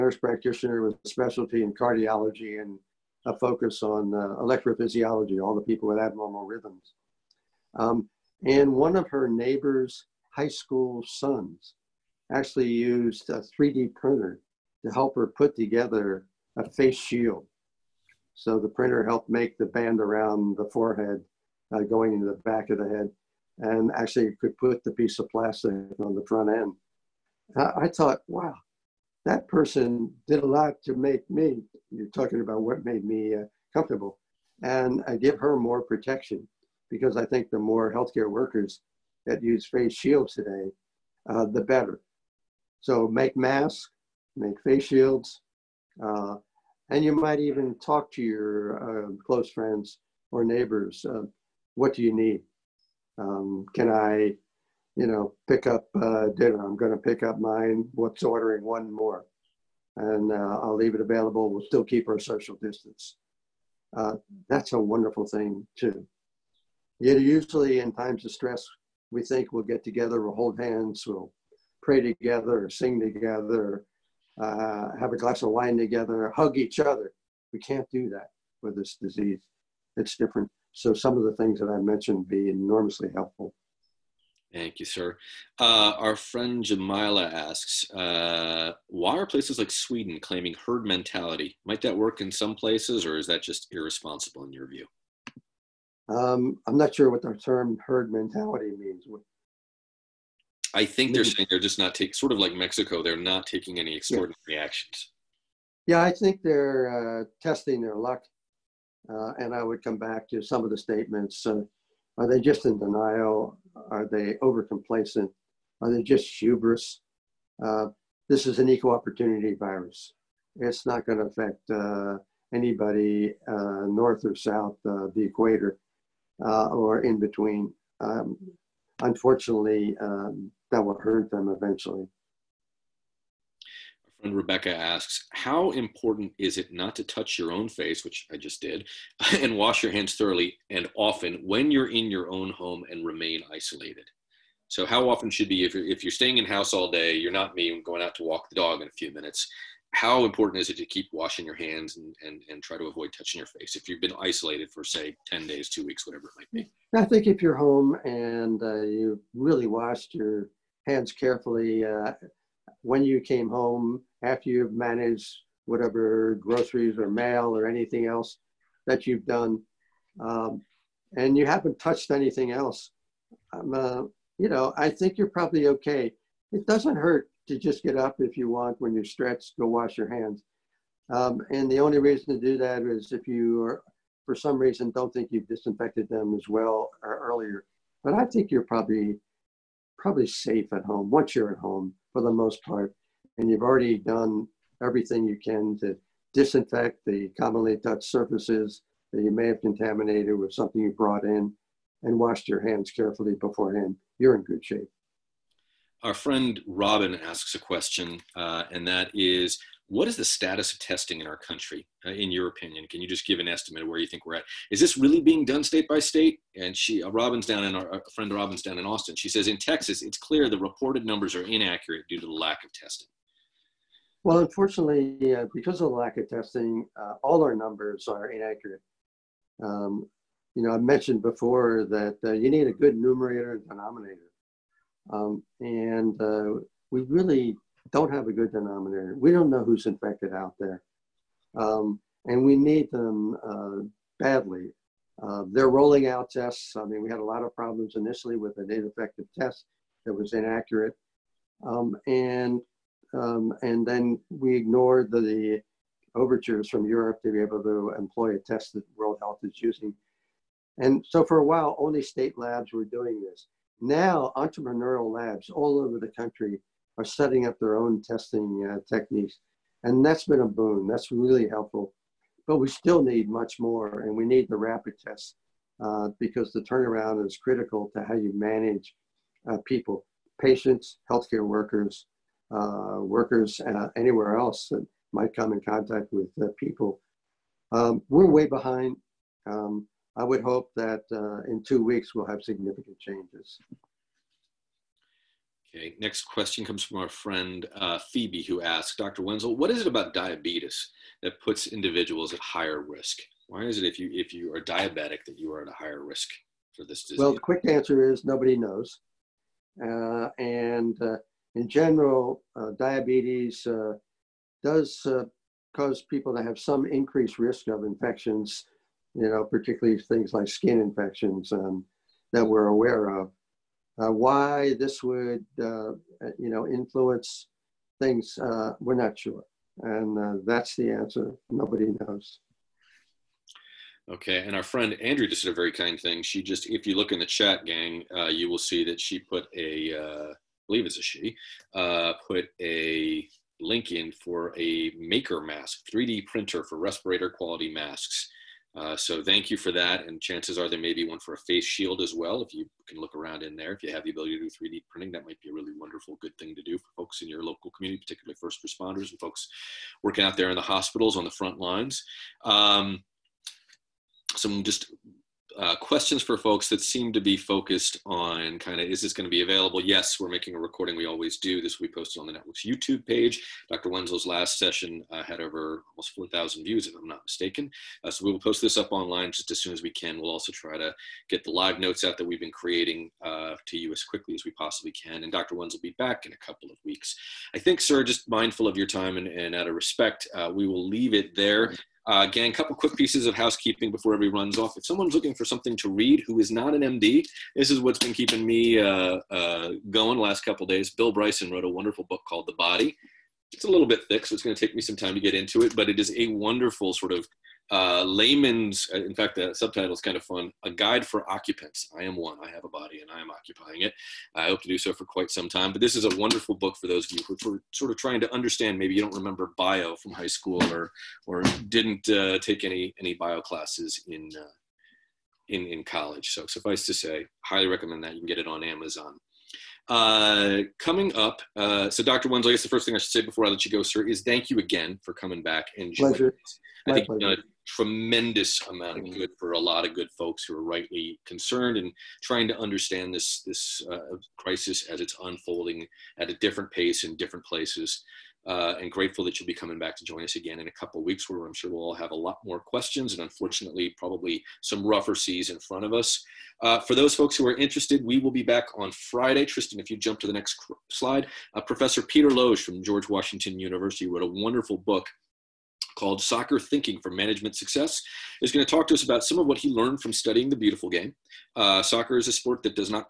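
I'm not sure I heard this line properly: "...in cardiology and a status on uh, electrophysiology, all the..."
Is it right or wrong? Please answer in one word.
wrong.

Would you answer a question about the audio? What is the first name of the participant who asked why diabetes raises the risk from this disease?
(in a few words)
Phoebe.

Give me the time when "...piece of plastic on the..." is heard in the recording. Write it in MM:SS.
00:24.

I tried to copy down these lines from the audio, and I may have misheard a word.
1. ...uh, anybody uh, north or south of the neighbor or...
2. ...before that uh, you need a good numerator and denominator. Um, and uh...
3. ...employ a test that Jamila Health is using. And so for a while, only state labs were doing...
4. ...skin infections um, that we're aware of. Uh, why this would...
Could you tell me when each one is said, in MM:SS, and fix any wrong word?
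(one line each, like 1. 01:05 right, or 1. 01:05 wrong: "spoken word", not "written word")
1. 02:01 wrong: "equator", not "neighbor"
2. 03:51 right
3. 04:17 wrong: "World", not "Jamila"
4. 05:20 right.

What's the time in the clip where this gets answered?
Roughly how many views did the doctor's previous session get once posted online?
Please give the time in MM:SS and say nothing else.
06:16.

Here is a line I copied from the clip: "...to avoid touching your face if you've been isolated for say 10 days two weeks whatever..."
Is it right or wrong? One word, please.
right.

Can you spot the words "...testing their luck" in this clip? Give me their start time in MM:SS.
01:47.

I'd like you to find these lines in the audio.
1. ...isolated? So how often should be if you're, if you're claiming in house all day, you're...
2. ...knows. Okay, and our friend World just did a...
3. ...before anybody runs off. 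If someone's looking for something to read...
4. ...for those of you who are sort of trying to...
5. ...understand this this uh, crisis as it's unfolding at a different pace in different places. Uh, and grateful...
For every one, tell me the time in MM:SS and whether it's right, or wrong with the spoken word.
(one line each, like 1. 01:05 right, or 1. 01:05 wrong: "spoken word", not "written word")
1. 02:23 wrong: "staying", not "claiming"
2. 05:32 wrong: "Andrew", not "World"
3. 06:33 wrong: "everybody", not "anybody"
4. 06:56 right
5. 07:22 right.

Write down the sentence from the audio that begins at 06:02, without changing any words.
Um, some just uh, questions for folks that seem to be focused on kind of is this going to be available?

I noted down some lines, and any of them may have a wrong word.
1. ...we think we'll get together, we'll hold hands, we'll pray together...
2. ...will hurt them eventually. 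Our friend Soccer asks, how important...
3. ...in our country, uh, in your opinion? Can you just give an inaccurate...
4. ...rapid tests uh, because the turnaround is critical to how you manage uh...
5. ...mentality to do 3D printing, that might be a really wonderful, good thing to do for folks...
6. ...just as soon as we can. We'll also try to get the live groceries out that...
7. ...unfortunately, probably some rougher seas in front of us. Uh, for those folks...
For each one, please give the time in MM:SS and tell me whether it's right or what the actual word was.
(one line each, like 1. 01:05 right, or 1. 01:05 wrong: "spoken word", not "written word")
1. 01:09 right
2. 02:10 wrong: "Rebecca", not "Soccer"
3. 03:31 wrong: "estimate", not "inaccurate"
4. 04:34 right
5. 05:54 wrong: "ability", not "mentality"
6. 06:19 wrong: "notes", not "groceries"
7. 07:33 right.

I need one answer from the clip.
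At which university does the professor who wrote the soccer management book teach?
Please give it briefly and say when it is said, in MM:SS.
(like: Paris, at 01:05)
George Washington University, at 07:42.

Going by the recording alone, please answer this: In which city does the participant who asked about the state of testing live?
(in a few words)
Austin.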